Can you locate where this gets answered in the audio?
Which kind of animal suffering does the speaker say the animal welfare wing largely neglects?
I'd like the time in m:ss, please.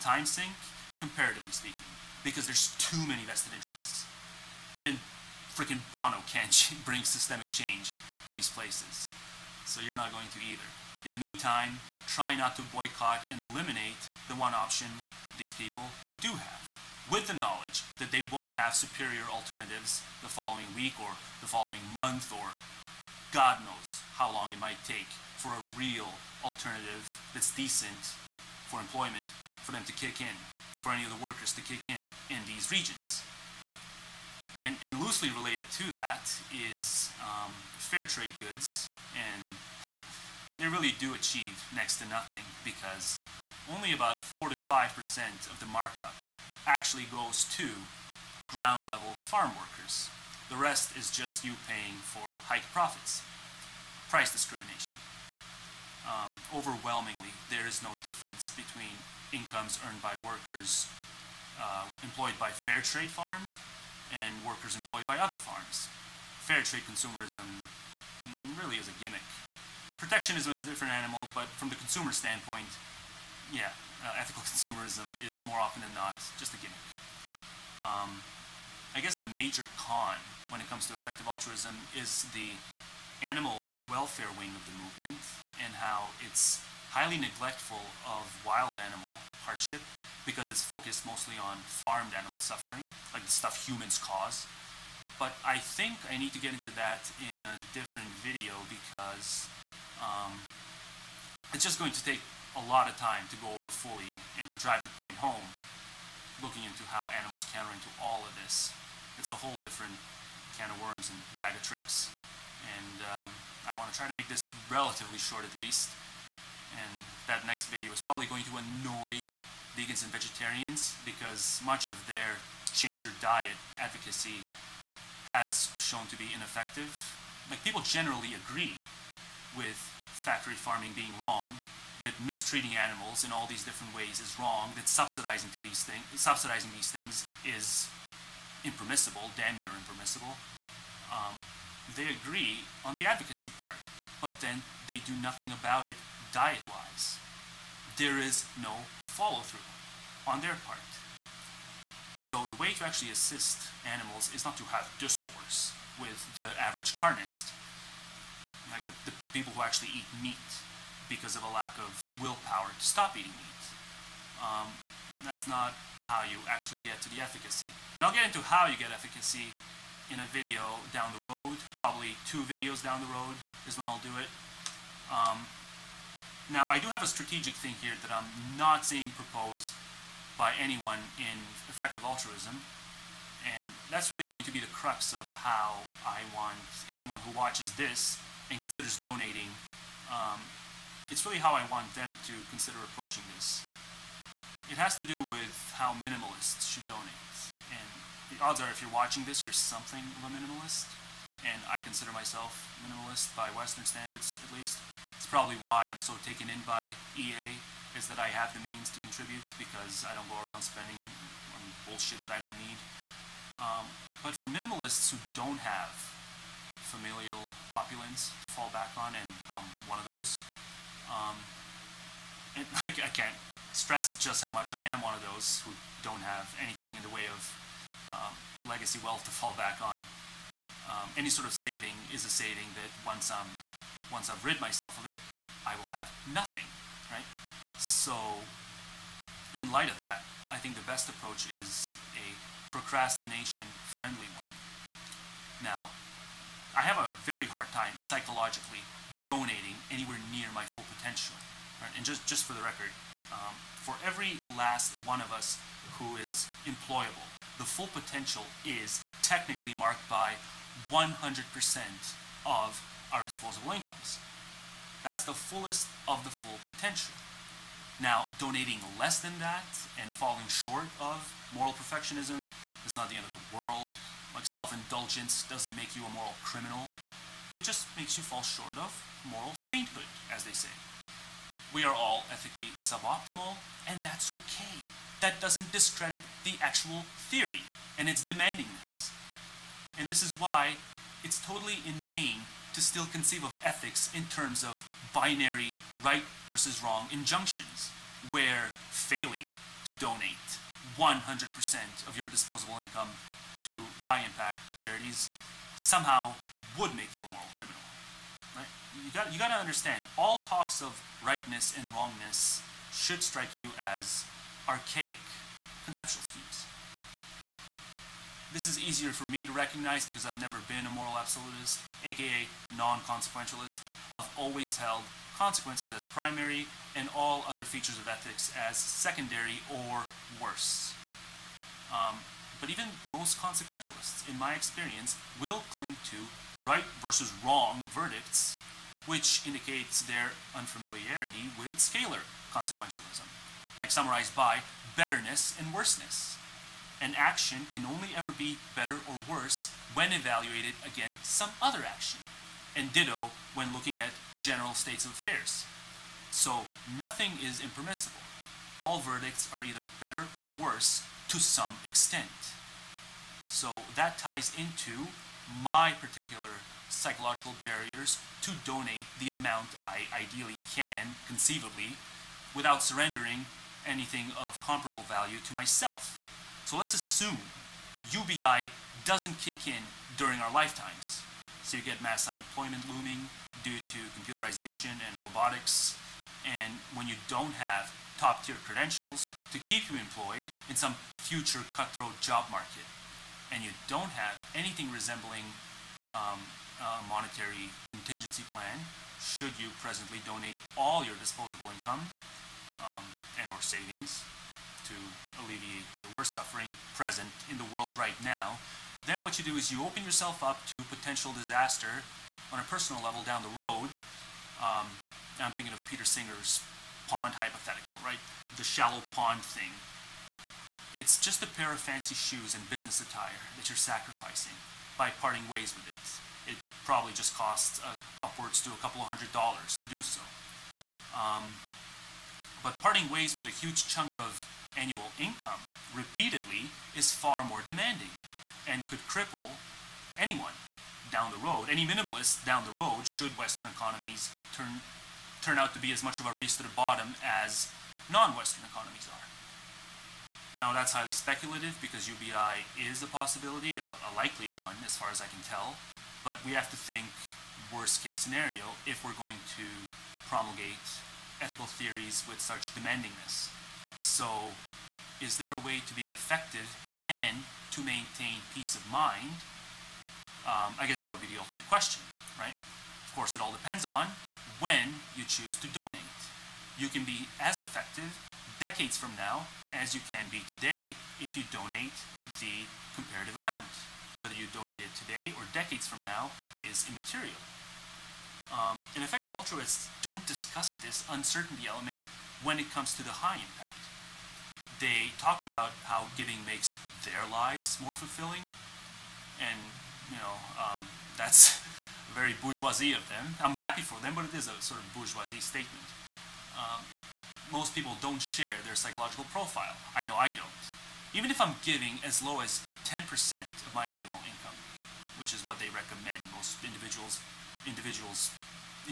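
1:28.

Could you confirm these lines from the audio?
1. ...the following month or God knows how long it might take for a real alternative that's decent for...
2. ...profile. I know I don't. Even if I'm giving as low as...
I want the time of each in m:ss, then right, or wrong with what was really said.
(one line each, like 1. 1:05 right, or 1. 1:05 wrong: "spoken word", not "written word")
1. 0:21 right
2. 8:29 right.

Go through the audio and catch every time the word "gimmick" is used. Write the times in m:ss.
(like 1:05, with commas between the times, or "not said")
1:08, 1:16.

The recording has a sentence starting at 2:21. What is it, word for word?
Um, they agree on the advocacy part, but then they do nothing about it diet-wise.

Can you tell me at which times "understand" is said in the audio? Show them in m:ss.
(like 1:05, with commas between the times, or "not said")
5:09.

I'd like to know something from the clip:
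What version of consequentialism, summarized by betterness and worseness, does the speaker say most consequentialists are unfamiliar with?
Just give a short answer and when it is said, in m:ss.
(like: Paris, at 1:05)
scalar consequentialism, at 5:41.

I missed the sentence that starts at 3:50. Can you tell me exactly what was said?
Um, any sort of saving is a saving that once I'm once I've rid myself of it, I will have nothing, right?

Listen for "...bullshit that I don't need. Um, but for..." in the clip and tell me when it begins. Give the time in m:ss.
3:31.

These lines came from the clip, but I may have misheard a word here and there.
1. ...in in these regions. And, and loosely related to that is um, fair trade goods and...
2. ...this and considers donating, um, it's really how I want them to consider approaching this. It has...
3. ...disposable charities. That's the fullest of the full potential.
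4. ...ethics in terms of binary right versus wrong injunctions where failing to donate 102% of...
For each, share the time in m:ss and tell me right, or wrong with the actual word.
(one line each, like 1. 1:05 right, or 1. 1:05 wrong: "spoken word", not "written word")
1. 0:31 right
2. 3:07 right
3. 4:23 wrong: "incomes", not "charities"
4. 4:53 wrong: "100", not "102".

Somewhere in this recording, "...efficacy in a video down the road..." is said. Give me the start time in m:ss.
2:48.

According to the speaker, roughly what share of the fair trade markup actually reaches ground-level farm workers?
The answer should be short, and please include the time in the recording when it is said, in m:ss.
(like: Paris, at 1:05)
4 to 5%, at 0:44.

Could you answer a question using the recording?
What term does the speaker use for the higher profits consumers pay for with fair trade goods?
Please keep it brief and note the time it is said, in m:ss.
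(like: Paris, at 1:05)
Price discrimination, at 0:54.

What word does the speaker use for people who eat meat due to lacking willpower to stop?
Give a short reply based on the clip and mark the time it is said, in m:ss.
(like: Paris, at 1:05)
carnist, at 2:36.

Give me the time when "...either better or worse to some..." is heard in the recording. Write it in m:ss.
5:59.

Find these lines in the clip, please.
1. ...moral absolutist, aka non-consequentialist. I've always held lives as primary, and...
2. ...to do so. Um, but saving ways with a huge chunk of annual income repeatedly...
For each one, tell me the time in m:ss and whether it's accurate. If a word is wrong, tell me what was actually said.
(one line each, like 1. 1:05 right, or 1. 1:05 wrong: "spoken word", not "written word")
1. 5:20 wrong: "consequences", not "lives"
2. 7:09 wrong: "parting", not "saving".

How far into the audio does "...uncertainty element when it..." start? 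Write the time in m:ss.
8:11.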